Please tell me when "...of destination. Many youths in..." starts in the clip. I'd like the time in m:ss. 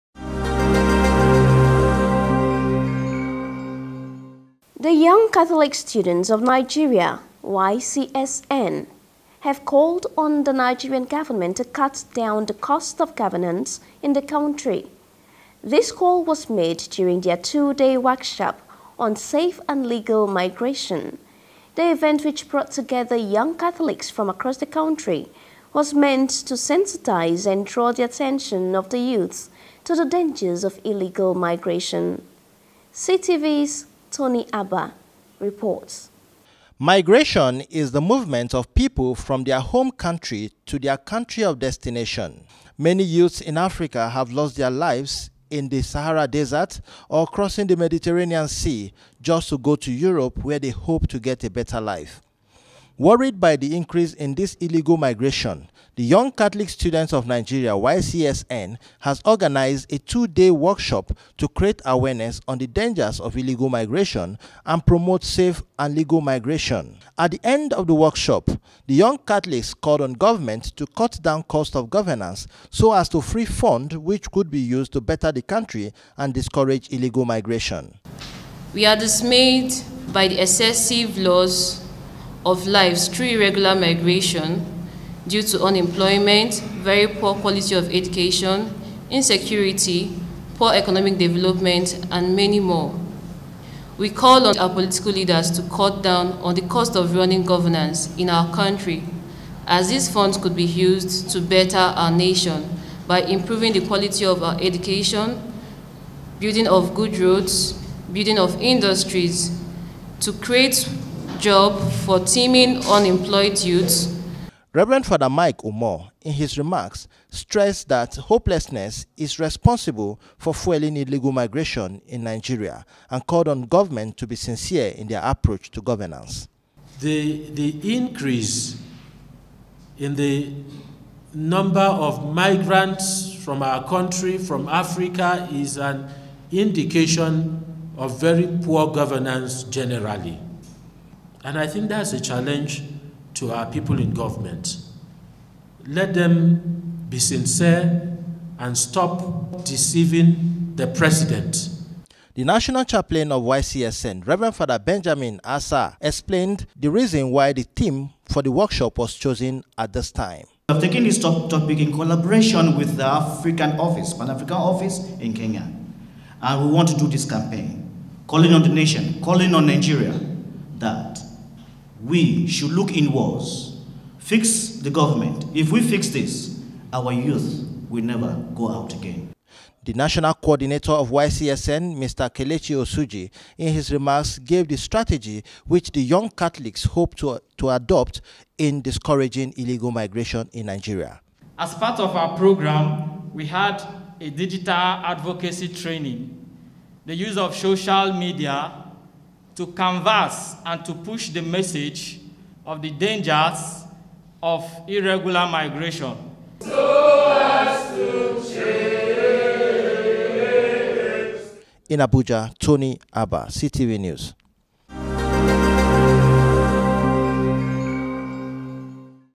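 0:41.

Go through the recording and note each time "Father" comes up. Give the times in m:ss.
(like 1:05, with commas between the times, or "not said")
1:55, 2:34.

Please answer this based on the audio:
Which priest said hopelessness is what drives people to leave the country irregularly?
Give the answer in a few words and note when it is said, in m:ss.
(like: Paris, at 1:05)
Mike Umor, at 1:55.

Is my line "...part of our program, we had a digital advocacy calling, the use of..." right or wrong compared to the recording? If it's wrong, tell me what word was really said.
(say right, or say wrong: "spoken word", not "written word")
wrong: "training", not "calling".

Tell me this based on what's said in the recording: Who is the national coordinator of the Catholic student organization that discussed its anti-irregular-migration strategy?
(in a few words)
Kelechi Osuji.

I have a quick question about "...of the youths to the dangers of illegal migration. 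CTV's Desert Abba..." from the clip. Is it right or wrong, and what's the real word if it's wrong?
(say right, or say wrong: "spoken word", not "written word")
wrong: "Tony", not "Desert".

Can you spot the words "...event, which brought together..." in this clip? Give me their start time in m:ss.
0:21.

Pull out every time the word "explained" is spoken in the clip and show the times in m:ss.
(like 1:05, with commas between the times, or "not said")
2:35.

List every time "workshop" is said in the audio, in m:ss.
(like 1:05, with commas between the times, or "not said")
0:17, 1:00, 1:07, 2:38.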